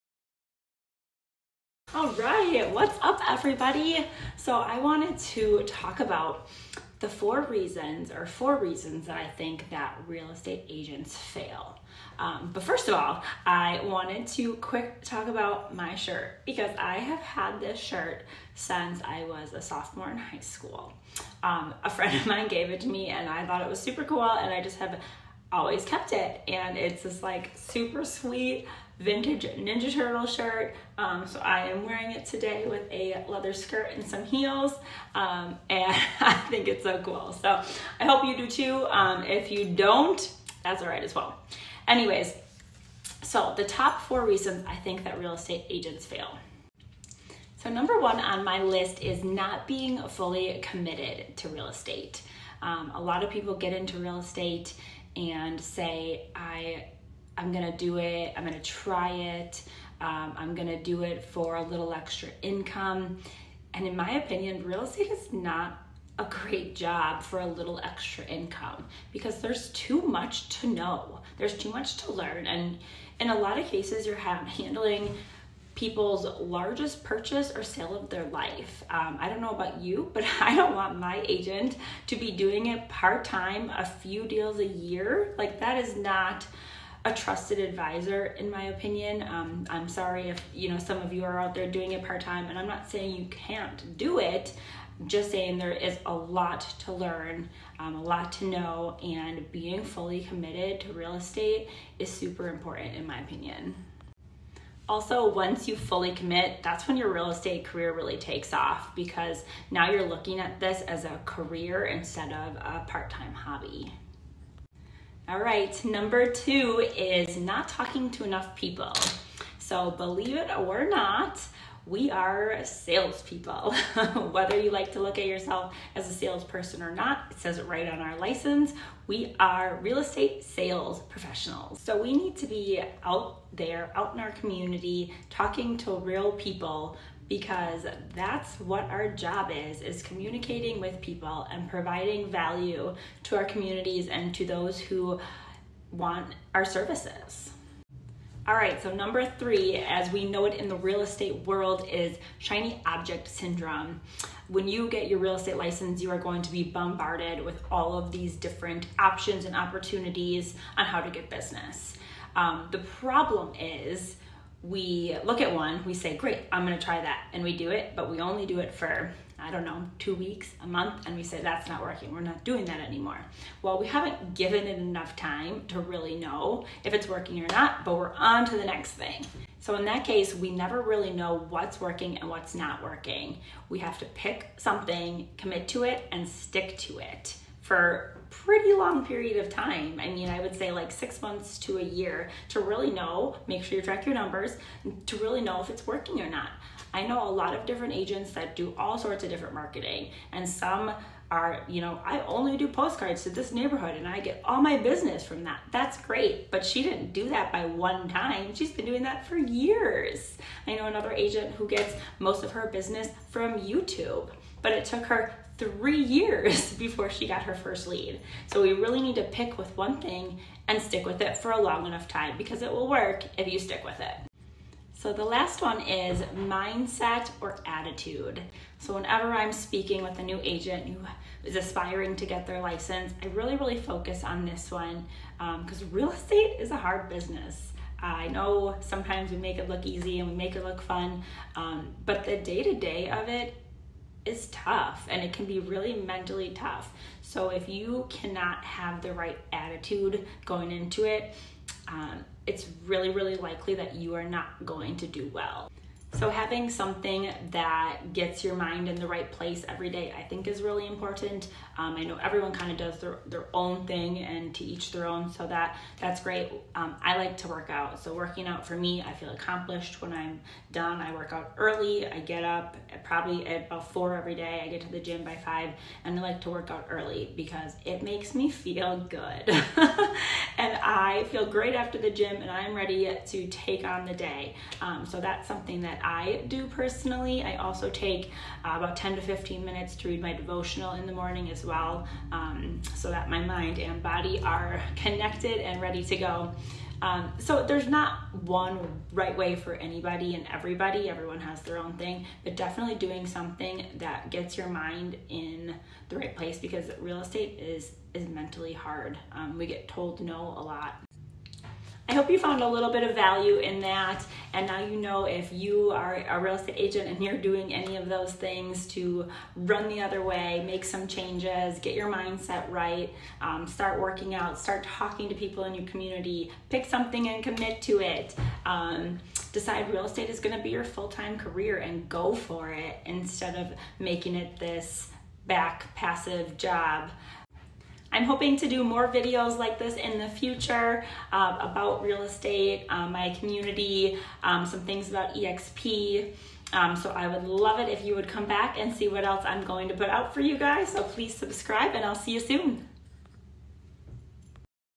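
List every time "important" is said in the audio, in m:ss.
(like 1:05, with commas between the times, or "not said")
1:42, 4:20.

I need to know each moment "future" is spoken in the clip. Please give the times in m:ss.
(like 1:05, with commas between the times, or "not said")
5:40.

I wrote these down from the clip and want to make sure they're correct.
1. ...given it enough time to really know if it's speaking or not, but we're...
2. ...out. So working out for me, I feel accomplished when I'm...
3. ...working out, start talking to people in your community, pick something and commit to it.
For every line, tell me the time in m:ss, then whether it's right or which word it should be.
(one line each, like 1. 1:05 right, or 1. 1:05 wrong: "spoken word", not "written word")
1. 2:54 wrong: "working", not "speaking"
2. 4:27 right
3. 5:24 right.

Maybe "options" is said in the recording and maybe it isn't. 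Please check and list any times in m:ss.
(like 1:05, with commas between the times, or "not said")
2:38.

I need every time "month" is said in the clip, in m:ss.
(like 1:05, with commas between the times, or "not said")
2:50, 3:11.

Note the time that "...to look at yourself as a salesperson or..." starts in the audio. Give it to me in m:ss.
2:04.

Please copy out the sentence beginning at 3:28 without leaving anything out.
She's been doing that for years.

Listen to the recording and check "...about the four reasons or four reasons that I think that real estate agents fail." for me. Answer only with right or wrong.
right.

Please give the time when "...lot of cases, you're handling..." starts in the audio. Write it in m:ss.
1:13.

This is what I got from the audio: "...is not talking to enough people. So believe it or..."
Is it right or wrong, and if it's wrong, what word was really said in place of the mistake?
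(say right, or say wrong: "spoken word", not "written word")
right.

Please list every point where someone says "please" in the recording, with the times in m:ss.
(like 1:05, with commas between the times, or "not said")
5:51.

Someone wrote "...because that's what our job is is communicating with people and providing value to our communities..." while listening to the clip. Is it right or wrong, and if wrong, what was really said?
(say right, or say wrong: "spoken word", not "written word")
right.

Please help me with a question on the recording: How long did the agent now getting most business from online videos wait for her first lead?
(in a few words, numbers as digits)
3 years.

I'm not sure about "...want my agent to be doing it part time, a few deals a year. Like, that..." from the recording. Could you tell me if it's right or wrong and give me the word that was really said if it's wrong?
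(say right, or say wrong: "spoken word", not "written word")
right.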